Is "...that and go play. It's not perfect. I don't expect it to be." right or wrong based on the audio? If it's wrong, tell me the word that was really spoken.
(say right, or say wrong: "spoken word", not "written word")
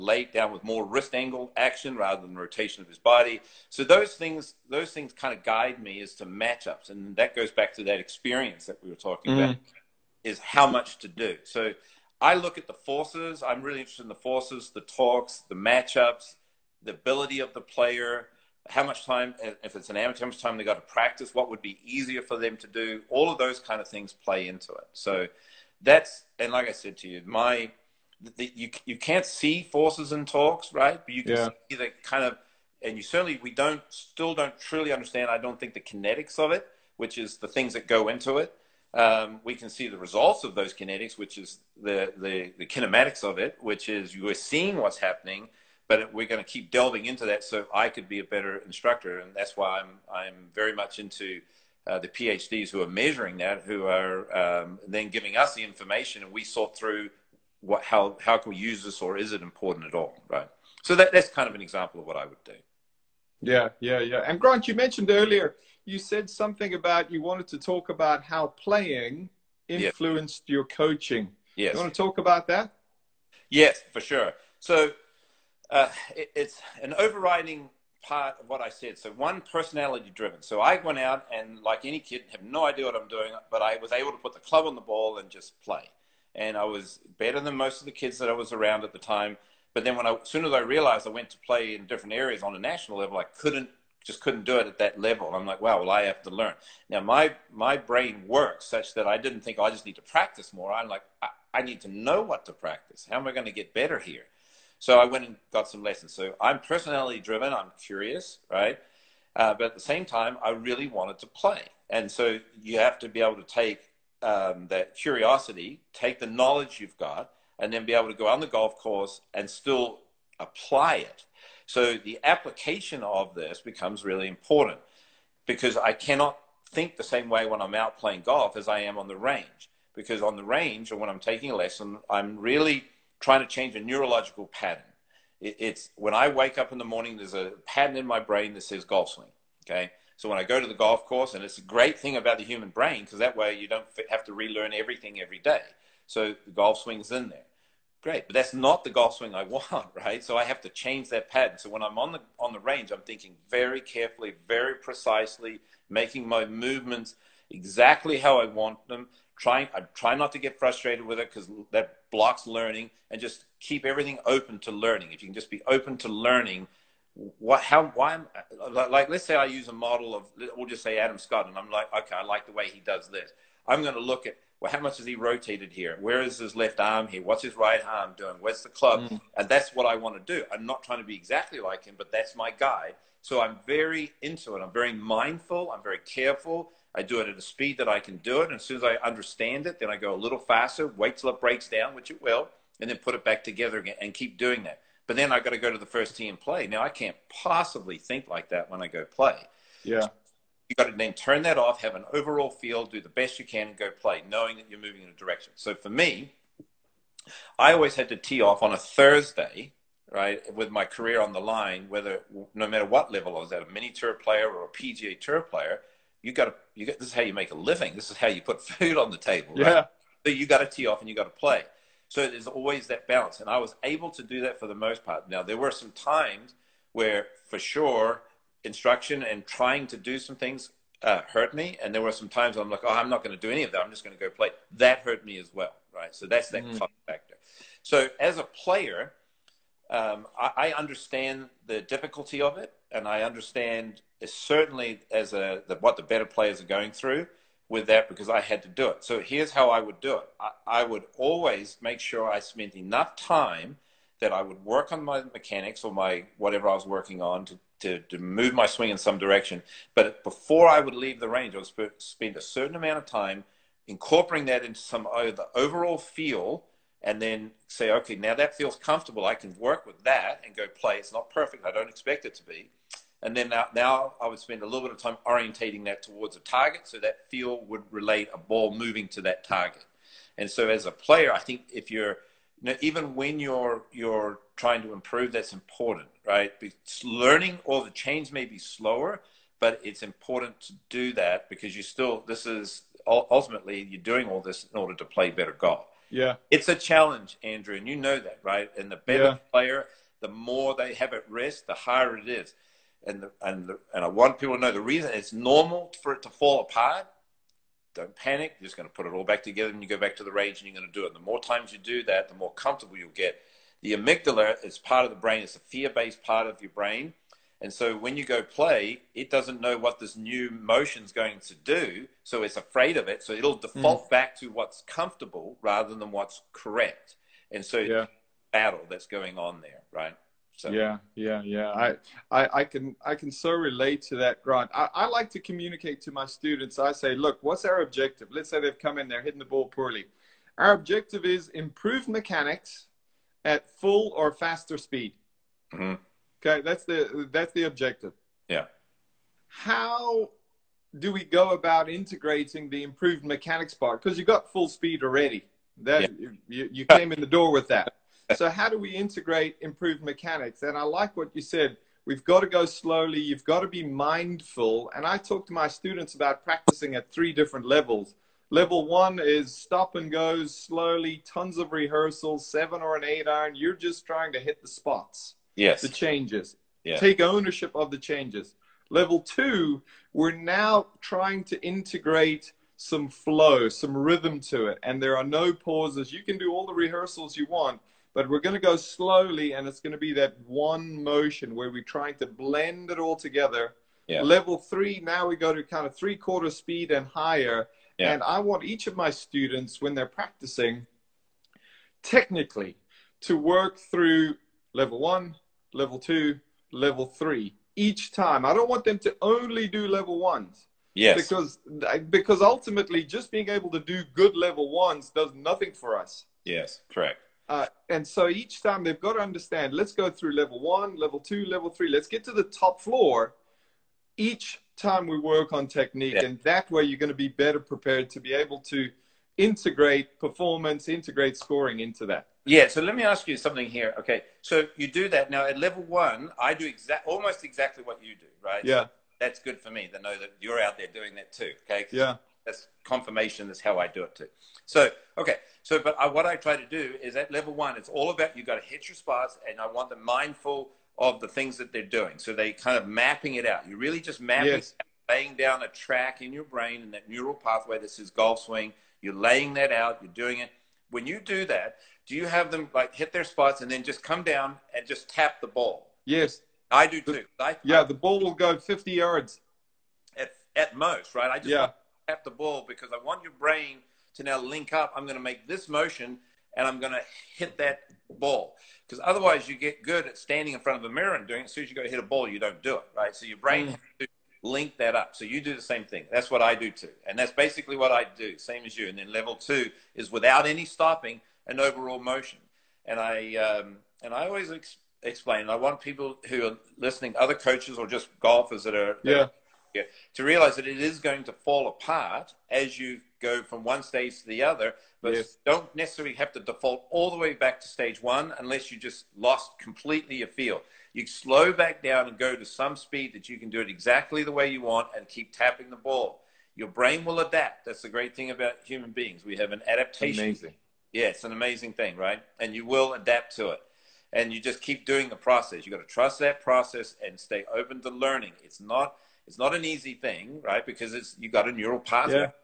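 right.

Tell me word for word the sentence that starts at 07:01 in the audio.
Let's get to the top floor each time we work on technique.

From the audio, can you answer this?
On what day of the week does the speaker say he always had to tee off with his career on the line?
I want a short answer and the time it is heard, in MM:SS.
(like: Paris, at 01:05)
Thursday, at 03:28.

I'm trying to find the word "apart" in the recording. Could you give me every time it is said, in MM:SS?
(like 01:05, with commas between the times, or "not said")
05:06, 08:21.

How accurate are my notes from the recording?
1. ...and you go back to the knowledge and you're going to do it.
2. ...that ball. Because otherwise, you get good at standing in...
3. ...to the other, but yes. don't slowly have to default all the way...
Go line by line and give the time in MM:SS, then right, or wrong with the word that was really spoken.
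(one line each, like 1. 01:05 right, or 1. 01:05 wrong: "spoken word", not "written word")
1. 05:09 wrong: "range", not "knowledge"
2. 07:57 right
3. 08:24 wrong: "necessarily", not "slowly".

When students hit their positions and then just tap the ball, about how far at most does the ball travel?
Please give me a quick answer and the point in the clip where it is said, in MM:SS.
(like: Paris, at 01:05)
50 yards, at 07:48.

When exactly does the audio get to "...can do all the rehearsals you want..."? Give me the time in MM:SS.
06:26.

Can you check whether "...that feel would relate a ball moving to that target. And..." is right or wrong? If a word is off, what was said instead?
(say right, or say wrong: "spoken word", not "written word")
right.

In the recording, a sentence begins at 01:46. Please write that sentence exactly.
So I'm personality driven, I'm curious, right?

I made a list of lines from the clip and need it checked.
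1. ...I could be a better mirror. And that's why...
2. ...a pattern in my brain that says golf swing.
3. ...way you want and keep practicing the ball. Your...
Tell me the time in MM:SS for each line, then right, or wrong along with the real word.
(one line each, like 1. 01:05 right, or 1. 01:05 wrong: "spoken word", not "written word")
1. 00:47 wrong: "instructor", not "mirror"
2. 02:17 right
3. 08:34 wrong: "tapping", not "practicing".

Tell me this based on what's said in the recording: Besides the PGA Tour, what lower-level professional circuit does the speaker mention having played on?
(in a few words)
mini tour.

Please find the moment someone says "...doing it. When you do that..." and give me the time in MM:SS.
07:40.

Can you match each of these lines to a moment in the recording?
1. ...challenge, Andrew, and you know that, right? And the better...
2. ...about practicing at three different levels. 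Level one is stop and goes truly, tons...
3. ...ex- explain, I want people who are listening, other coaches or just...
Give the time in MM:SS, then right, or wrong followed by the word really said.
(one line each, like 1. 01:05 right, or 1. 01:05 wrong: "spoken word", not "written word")
1. 04:56 right
2. 06:06 wrong: "slowly", not "truly"
3. 08:14 right.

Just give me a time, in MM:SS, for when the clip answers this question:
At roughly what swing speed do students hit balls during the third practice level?
06:35.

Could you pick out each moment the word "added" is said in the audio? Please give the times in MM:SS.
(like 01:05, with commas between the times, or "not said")
not said.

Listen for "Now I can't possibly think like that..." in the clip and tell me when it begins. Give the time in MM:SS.
03:16.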